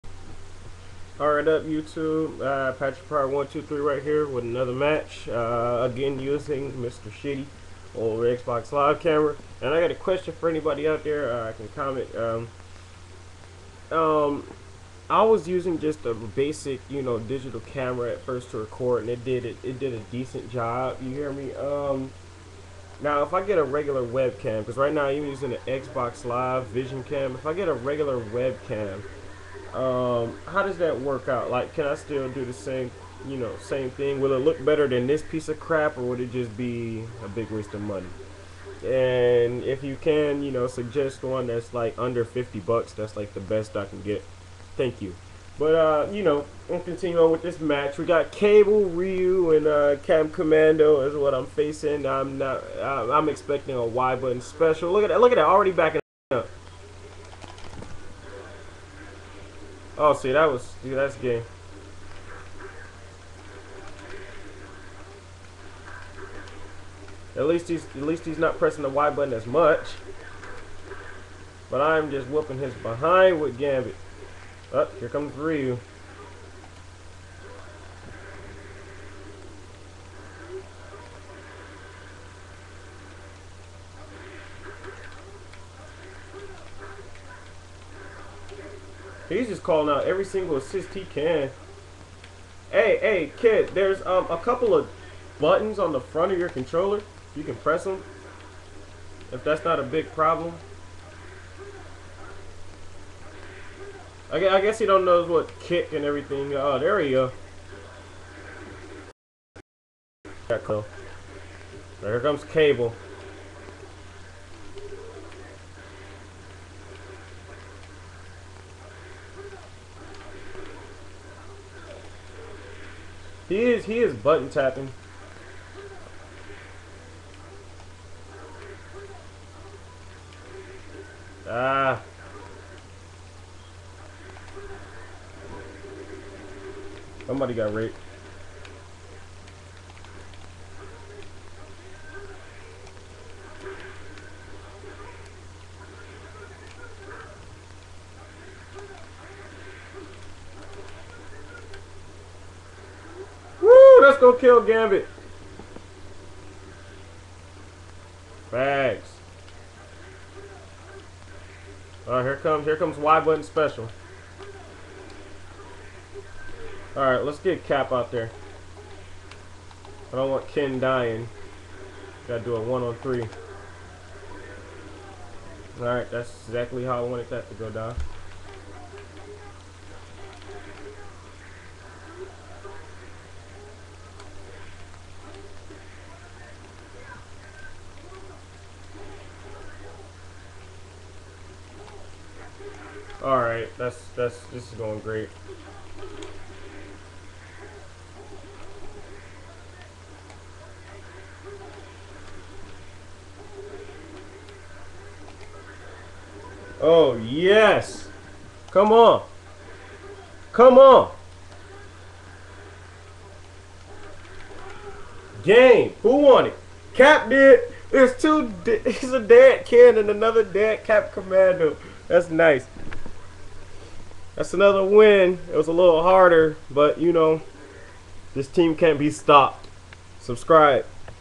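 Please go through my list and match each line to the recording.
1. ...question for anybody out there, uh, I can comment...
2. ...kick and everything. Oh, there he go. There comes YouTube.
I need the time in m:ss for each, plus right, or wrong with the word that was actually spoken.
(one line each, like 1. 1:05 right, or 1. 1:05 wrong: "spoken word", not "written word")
1. 0:09 right
2. 1:45 wrong: "Cable", not "YouTube".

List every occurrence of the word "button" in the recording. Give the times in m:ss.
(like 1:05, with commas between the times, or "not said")
0:54, 1:09, 1:35, 2:04, 2:43.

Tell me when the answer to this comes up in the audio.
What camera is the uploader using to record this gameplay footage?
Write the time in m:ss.
0:25.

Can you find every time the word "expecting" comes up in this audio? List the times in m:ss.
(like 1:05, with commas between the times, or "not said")
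0:53.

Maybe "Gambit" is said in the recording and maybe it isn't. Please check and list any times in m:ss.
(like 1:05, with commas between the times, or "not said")
1:13, 2:34.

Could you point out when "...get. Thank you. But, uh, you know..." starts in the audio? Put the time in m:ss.
0:44.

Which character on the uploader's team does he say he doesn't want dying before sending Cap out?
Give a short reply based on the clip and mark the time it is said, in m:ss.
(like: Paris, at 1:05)
Ken, at 2:50.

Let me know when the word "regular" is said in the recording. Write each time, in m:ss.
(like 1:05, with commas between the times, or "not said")
0:23, 0:27.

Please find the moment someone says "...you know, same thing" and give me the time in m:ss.
0:33.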